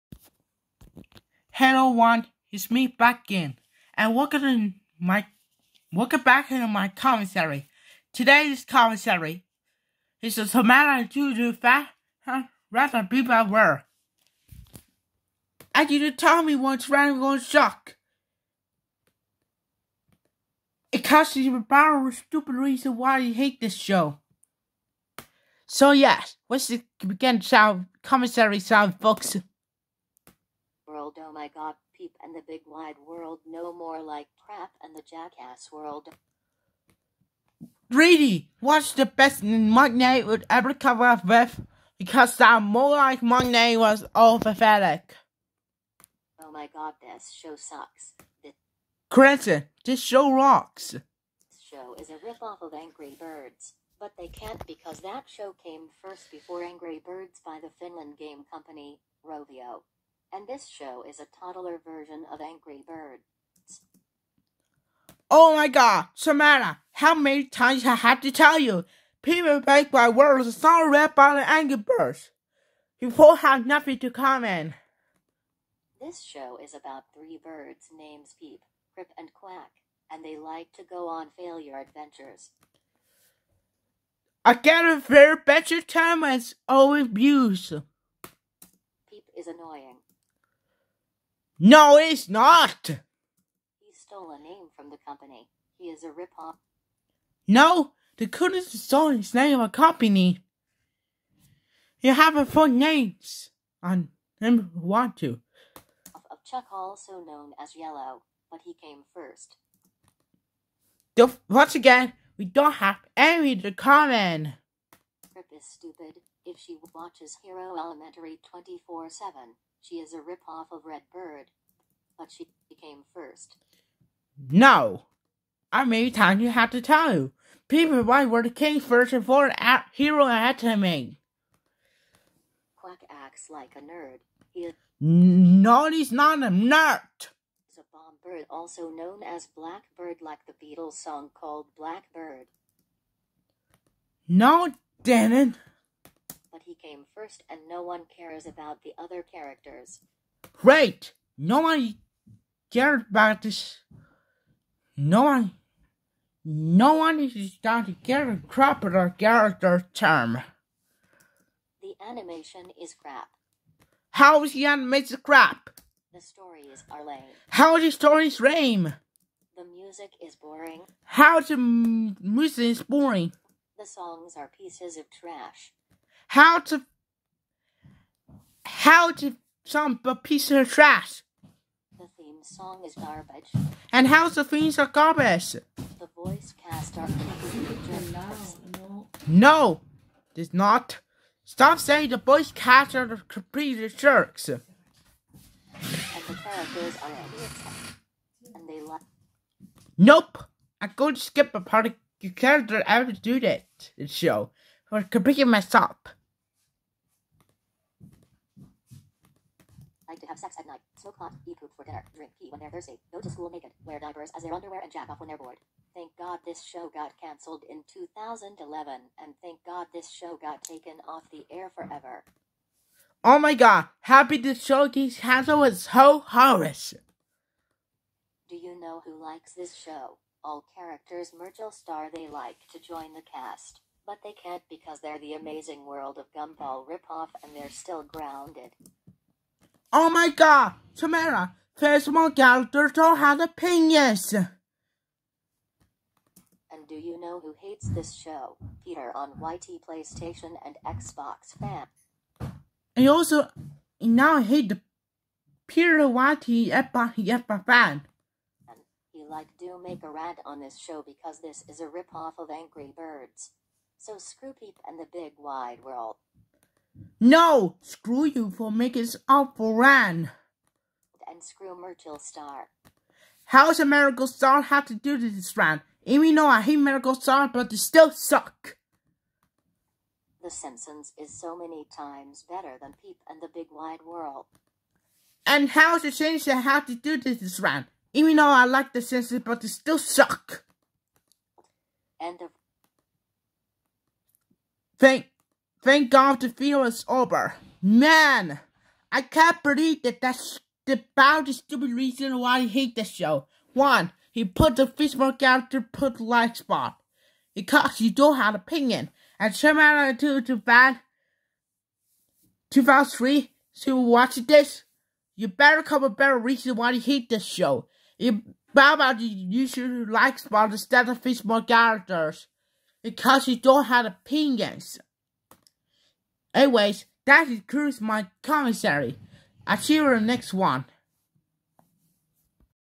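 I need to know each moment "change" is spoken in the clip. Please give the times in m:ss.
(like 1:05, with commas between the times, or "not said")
4:46.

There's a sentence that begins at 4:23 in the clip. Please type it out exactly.
So screw peep and the big wide world.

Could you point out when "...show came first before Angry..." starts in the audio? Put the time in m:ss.
0:55.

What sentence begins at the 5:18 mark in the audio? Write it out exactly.
You about you should like spot instead of Facebook characters.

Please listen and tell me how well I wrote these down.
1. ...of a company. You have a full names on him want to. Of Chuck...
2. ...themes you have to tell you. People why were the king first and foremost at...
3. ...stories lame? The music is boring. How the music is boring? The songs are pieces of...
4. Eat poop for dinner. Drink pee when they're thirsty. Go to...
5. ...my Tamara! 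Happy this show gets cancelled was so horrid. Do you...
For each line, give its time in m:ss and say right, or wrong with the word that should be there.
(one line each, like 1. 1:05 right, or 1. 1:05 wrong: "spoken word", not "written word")
1. 1:39 right
2. 2:06 wrong: "times", not "themes"
3. 2:47 right
4. 3:31 right
5. 3:43 wrong: "God", not "Tamara".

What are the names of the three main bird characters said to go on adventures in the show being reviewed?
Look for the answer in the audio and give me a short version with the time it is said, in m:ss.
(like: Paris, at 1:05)
Peep, Chirp, and Quack, at 1:18.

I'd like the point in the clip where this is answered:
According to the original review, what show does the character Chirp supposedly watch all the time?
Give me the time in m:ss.
1:57.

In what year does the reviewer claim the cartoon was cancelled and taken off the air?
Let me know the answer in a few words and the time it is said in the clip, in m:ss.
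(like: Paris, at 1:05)
2011, at 3:37.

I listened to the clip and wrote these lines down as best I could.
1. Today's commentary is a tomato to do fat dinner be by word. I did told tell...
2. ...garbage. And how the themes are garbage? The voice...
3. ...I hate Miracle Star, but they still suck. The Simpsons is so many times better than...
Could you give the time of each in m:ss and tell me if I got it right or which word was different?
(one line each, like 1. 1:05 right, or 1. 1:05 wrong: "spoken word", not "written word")
1. 0:08 wrong: "rather", not "dinner"
2. 3:02 right
3. 4:36 right.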